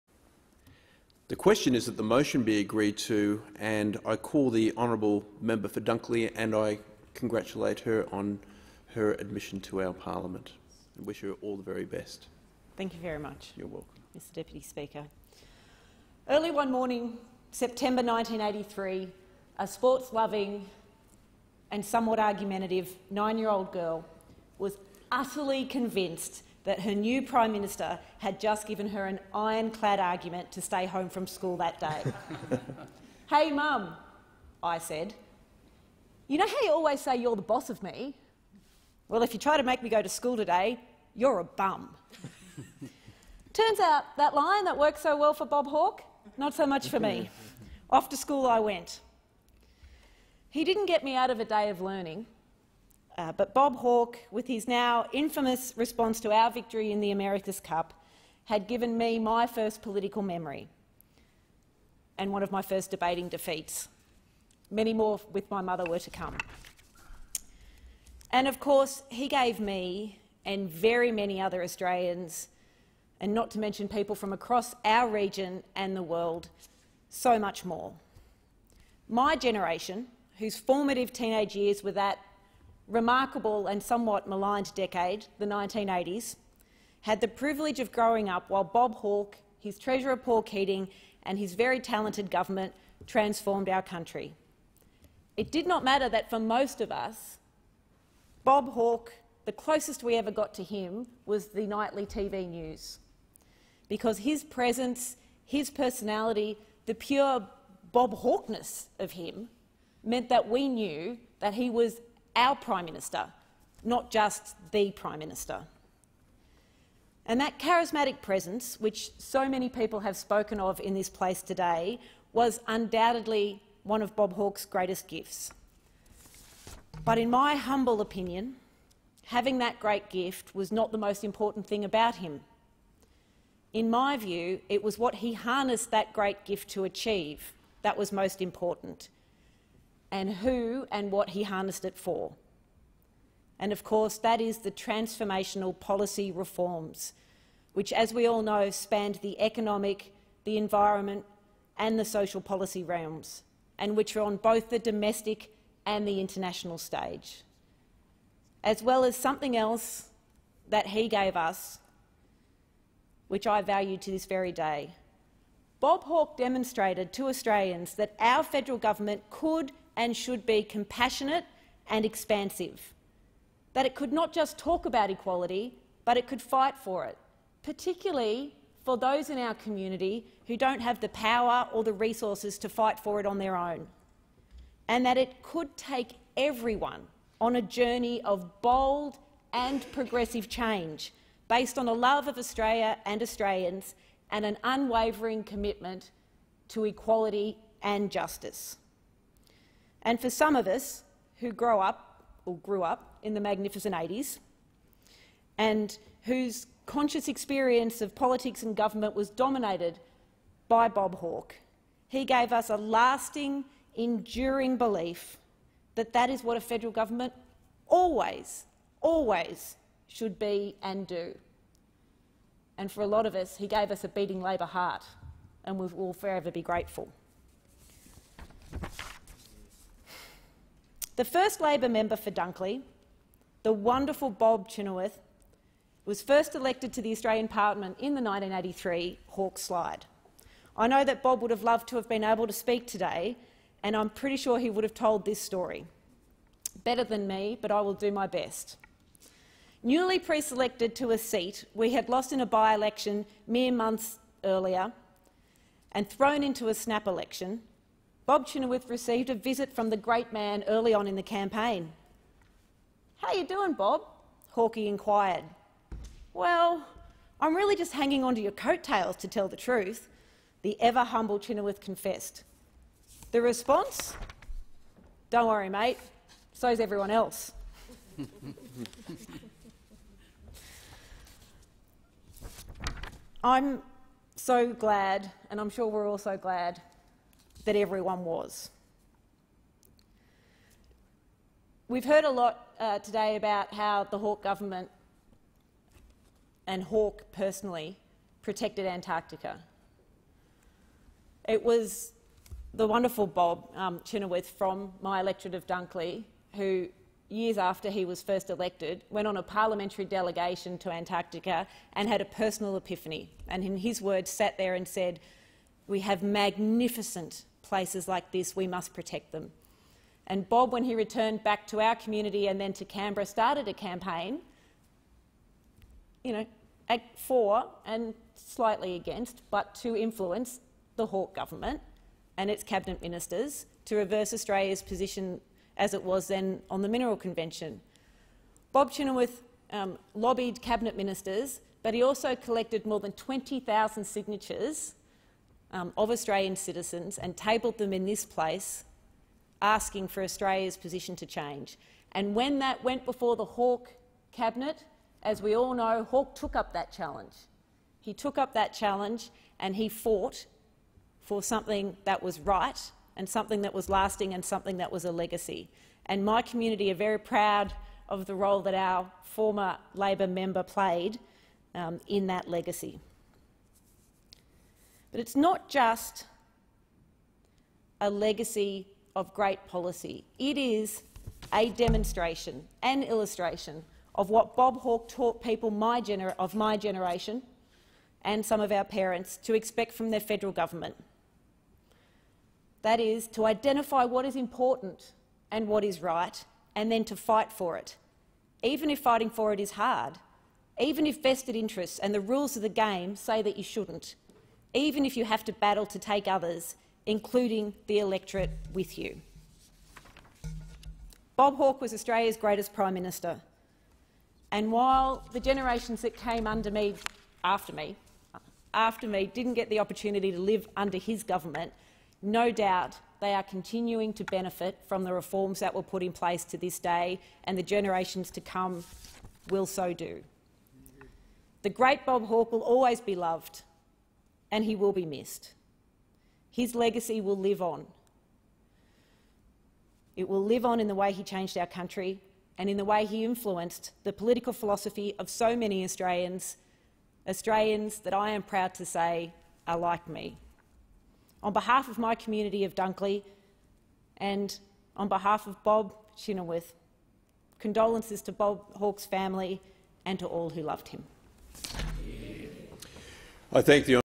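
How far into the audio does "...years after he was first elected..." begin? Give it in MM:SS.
05:07.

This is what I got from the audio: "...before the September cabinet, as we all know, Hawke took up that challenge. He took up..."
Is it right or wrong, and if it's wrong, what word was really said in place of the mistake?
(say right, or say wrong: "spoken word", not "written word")
wrong: "Hawke", not "September".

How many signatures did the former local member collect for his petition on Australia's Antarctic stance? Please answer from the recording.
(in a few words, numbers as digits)
More than 20,000.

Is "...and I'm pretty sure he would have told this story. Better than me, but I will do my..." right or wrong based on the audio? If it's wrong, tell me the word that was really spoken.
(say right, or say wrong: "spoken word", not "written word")
right.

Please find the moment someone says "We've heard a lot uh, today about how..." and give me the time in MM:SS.
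04:51.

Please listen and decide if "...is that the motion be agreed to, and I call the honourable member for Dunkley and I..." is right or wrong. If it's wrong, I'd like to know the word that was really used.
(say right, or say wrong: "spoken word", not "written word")
right.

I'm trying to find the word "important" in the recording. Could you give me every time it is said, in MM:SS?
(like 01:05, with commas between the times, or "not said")
02:11, 02:18, 06:34.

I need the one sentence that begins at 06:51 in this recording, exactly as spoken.
Bob Hawke was Australia's greatest Prime Minister.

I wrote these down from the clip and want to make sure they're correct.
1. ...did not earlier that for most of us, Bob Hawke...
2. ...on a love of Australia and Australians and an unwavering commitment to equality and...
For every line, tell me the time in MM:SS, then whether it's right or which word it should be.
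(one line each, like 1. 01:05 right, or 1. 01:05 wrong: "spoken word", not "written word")
1. 01:35 wrong: "matter", not "earlier"
2. 03:11 right.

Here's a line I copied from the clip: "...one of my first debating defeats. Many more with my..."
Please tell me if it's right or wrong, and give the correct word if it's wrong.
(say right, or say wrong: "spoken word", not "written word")
right.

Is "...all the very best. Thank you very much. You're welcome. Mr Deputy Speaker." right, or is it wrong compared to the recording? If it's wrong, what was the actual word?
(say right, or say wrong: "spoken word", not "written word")
right.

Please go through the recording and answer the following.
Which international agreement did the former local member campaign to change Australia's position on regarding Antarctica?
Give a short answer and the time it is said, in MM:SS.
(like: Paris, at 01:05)
Mineral Convention, at 05:36.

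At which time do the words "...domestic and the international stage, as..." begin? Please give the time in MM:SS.
02:34.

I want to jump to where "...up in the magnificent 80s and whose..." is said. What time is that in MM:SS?
03:22.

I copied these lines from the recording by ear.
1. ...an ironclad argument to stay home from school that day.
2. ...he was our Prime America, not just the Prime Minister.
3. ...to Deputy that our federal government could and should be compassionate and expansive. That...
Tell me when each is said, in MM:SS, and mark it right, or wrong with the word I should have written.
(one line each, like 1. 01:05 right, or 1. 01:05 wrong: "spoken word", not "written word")
1. 00:29 right
2. 01:51 wrong: "Minister", not "America"
3. 02:47 wrong: "Australians", not "Deputy".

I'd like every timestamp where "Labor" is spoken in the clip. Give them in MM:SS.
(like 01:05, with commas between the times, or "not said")
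03:44, 03:51, 06:09.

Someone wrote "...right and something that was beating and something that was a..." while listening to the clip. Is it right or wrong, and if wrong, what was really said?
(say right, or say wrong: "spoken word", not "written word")
wrong: "lasting", not "beating".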